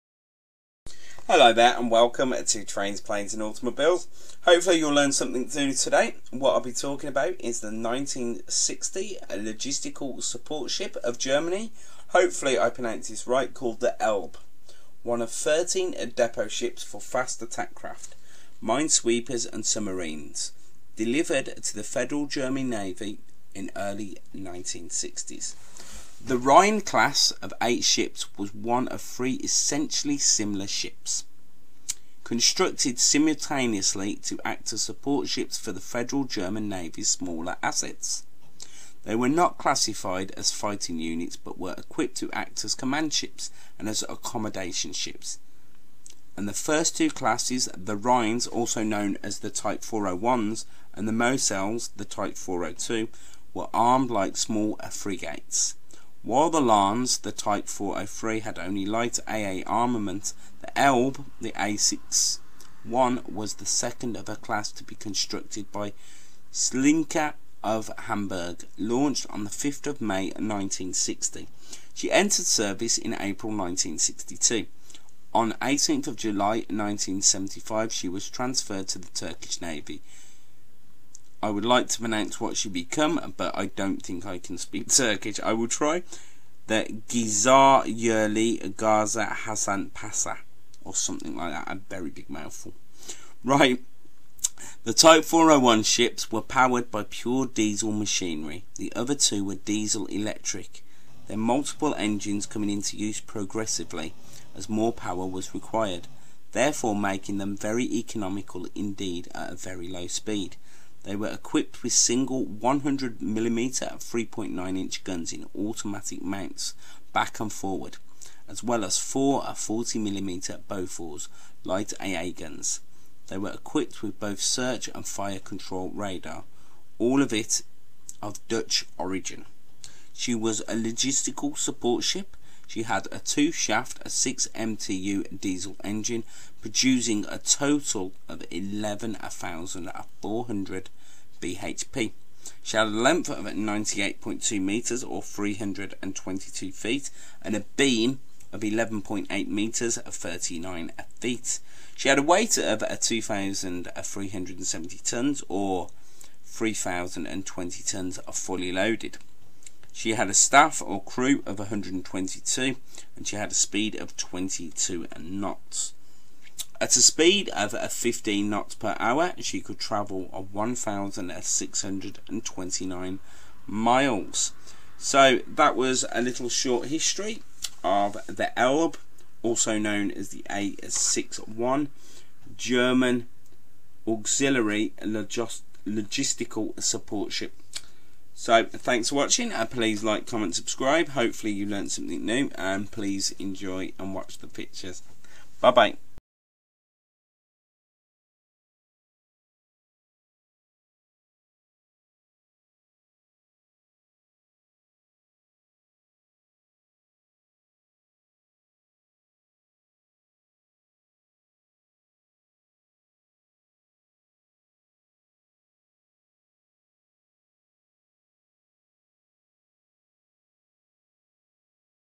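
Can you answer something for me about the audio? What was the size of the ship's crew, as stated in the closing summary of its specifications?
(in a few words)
122.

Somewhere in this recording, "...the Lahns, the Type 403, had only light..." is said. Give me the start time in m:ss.
0:56.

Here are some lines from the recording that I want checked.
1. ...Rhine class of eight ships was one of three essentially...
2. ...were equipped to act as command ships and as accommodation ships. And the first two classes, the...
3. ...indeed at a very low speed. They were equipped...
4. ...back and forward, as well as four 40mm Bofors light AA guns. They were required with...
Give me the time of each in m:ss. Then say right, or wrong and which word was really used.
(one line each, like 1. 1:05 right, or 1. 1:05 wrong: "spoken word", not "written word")
1. 0:26 right
2. 0:41 right
3. 1:48 right
4. 1:57 wrong: "equipped", not "required".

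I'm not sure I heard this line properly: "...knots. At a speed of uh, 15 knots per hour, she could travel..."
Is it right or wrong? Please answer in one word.
right.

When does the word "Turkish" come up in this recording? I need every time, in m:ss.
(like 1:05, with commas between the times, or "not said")
1:19, 1:24.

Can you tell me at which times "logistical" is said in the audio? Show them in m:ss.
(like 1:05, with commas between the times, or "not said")
0:09, 2:10, 3:05.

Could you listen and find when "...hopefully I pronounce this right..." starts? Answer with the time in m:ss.
0:12.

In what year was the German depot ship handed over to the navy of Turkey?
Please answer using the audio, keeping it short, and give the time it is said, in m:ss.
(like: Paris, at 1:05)
1975, at 1:16.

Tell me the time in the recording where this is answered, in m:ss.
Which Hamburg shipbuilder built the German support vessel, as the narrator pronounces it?
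1:06.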